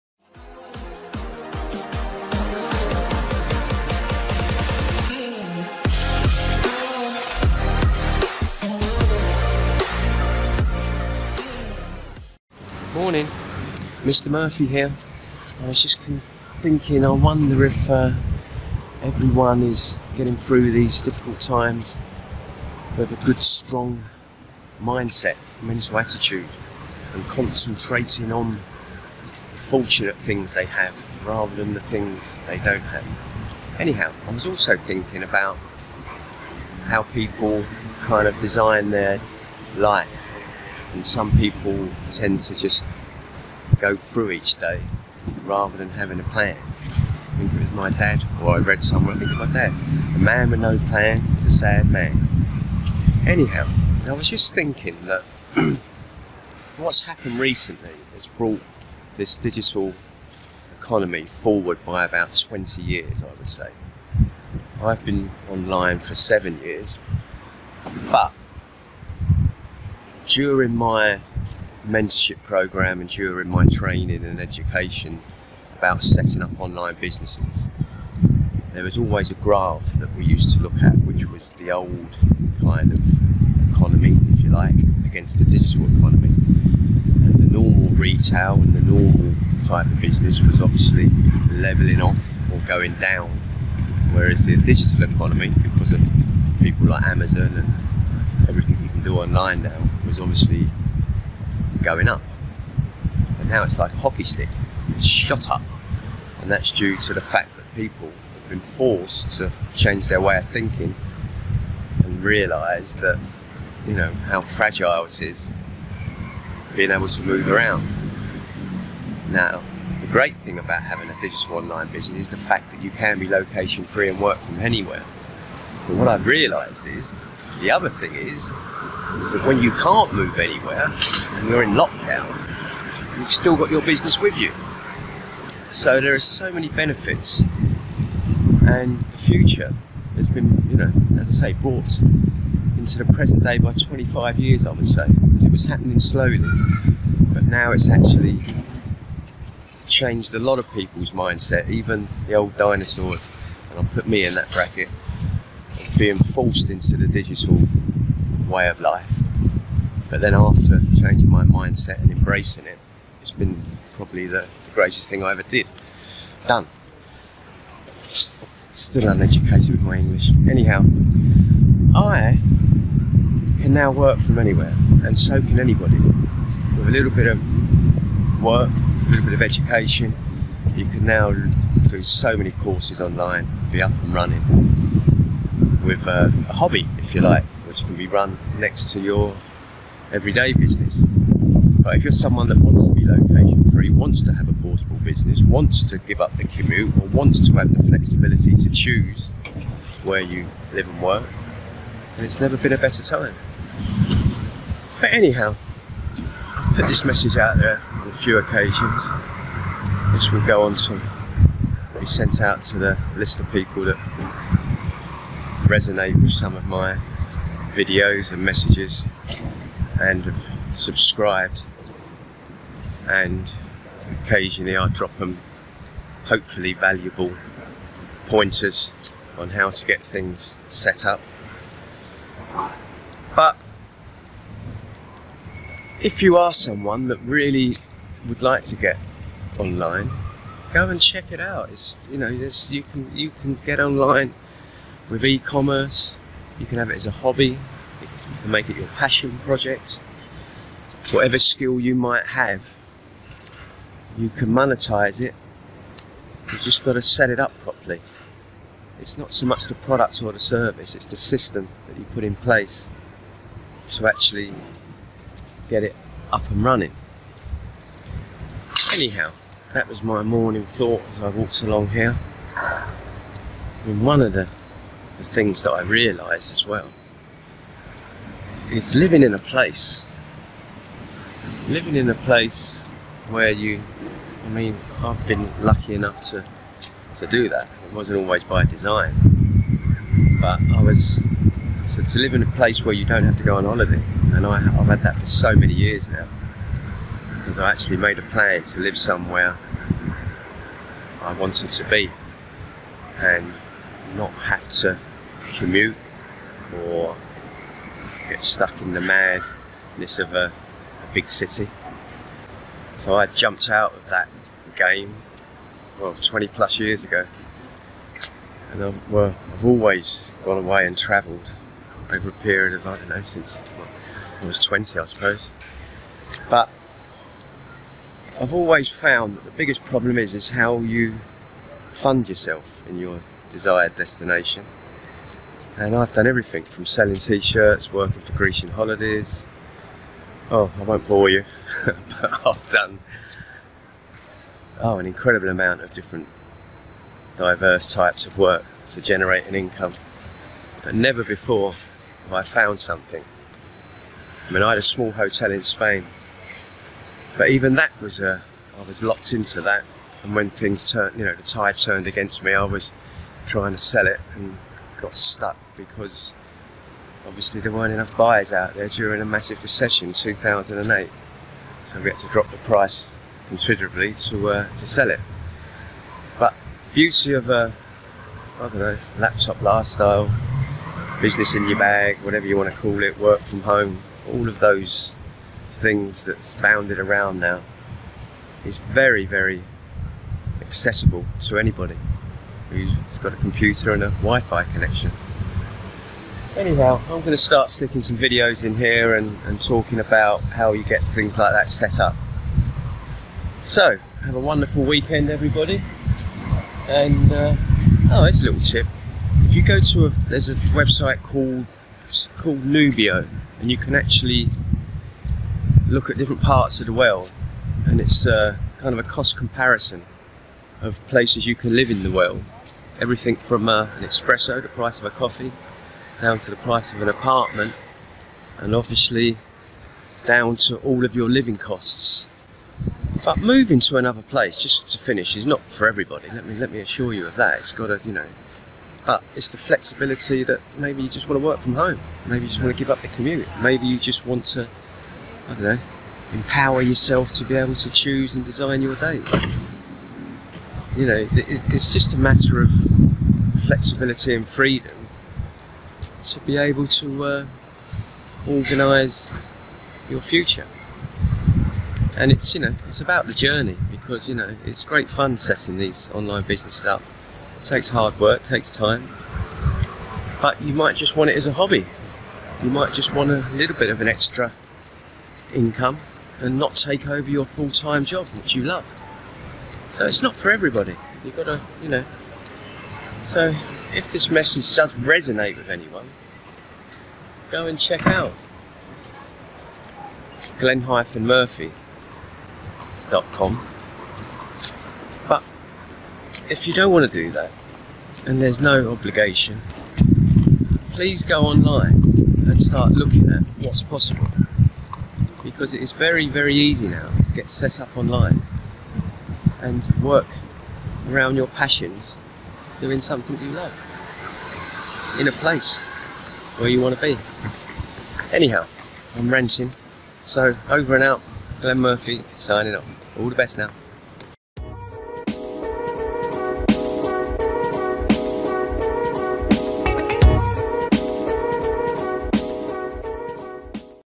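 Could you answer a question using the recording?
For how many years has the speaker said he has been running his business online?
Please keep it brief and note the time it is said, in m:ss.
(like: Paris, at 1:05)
7, at 1:06.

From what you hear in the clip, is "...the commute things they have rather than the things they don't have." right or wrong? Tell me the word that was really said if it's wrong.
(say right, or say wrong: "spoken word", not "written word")
wrong: "fortunate", not "commute".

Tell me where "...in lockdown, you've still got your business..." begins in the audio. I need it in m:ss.
2:11.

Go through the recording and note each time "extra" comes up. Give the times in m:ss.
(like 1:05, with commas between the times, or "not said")
7:54.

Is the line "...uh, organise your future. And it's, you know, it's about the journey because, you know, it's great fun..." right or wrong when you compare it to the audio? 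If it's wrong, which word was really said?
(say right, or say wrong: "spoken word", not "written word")
right.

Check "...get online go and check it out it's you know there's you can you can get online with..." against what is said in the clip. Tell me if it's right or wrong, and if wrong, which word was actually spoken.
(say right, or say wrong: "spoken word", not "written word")
right.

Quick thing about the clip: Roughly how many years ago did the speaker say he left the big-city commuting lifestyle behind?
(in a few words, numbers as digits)
20 plus.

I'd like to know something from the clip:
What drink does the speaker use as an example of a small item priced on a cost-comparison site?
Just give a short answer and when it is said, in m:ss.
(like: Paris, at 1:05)
espresso, at 7:04.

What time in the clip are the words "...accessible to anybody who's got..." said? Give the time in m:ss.
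6:30.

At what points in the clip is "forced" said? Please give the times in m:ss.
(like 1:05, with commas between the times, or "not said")
1:48, 2:36.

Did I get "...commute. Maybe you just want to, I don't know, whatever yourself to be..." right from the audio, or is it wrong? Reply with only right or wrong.
wrong.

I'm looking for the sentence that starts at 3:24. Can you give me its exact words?
But anyhow, I've put this message out there on a few occasions.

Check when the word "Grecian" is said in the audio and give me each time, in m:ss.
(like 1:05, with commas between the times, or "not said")
5:38.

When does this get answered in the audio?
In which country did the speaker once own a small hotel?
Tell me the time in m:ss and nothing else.
5:55.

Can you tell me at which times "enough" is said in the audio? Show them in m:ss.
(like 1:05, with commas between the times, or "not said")
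4:45, 6:07.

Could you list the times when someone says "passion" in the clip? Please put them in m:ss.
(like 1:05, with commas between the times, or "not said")
4:08, 8:31.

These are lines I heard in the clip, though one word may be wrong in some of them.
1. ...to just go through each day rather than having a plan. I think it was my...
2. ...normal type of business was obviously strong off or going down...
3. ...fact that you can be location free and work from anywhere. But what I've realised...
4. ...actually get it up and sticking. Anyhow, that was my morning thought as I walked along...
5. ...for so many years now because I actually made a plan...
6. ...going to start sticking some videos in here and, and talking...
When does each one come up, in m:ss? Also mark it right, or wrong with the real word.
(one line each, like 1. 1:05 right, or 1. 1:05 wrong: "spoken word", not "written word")
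1. 0:42 right
2. 1:28 wrong: "leveling", not "strong"
3. 2:02 right
4. 4:24 wrong: "running", not "sticking"
5. 4:55 right
6. 6:37 right.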